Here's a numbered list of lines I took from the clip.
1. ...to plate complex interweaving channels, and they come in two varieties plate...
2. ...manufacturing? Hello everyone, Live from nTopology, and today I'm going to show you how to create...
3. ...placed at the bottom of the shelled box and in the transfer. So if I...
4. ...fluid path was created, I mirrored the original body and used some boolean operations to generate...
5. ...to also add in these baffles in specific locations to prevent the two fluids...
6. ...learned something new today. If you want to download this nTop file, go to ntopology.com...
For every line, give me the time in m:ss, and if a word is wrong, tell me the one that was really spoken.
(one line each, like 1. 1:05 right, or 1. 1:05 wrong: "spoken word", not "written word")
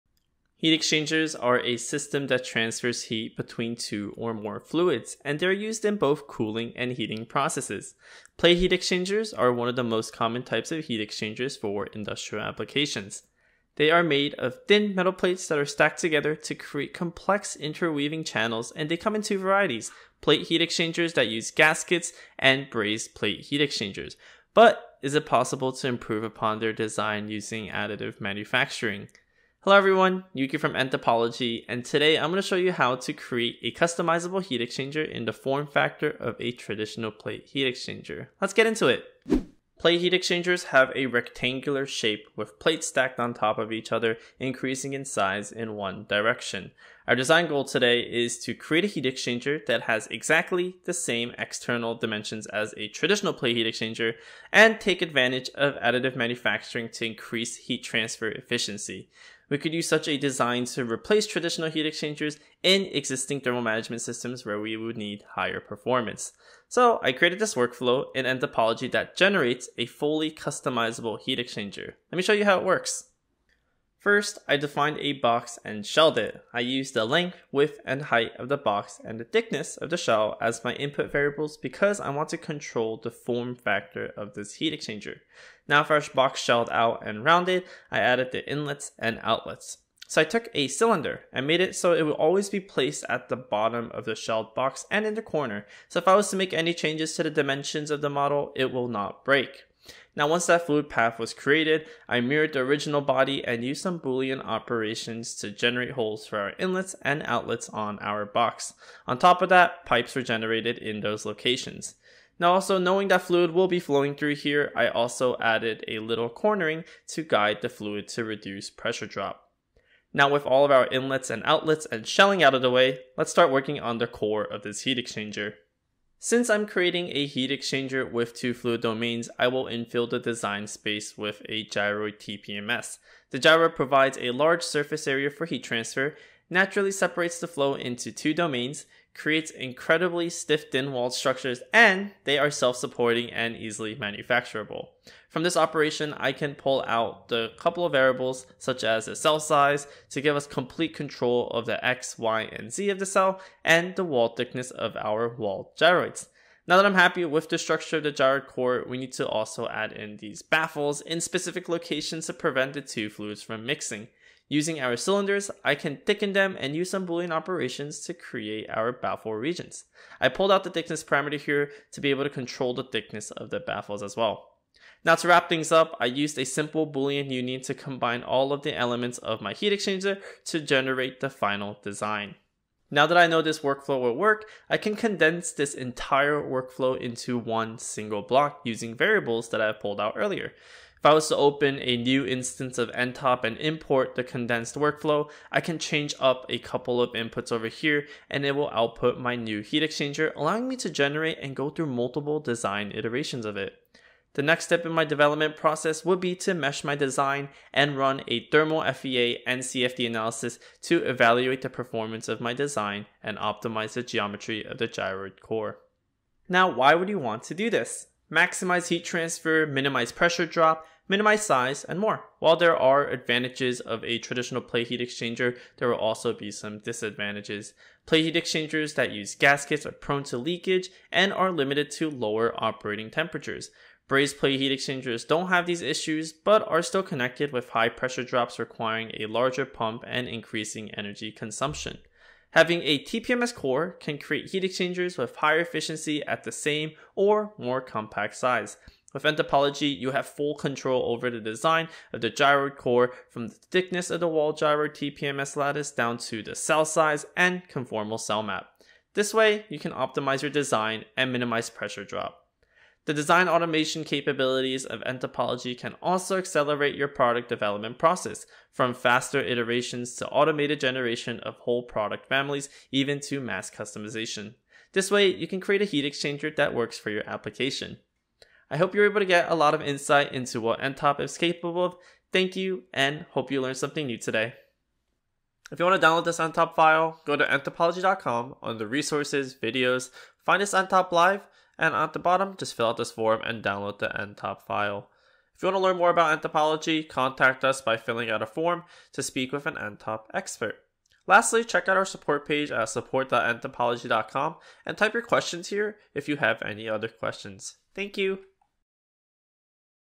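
1. 0:16 wrong: "create", not "plate"
2. 0:28 wrong: "Yuki", not "Live"
3. 1:32 wrong: "corner", not "transfer"
4. 1:40 right
5. 2:39 right
6. 4:43 right.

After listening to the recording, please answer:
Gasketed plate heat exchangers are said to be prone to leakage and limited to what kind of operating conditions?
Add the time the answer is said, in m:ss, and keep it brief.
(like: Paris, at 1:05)
Lower operating temperatures, at 3:52.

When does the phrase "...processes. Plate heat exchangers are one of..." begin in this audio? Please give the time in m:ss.
0:07.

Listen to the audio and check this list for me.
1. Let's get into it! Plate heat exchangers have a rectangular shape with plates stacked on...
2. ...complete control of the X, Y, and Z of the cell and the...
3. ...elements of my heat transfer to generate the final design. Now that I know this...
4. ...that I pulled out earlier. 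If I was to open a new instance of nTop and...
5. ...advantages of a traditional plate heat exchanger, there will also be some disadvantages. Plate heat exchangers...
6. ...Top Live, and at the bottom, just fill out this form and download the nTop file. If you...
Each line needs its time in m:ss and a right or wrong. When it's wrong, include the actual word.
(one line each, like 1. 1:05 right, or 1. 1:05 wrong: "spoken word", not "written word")
1. 0:38 right
2. 2:30 right
3. 2:58 wrong: "exchanger", not "transfer"
4. 3:09 right
5. 3:43 right
6. 4:50 right.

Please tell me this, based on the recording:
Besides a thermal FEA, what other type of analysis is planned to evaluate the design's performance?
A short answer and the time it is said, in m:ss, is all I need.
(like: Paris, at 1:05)
CFD, at 3:29.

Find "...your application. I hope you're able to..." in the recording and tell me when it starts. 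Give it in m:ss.
4:37.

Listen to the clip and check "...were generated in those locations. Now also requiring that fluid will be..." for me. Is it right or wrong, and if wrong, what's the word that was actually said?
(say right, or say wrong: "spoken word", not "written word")
wrong: "knowing", not "requiring".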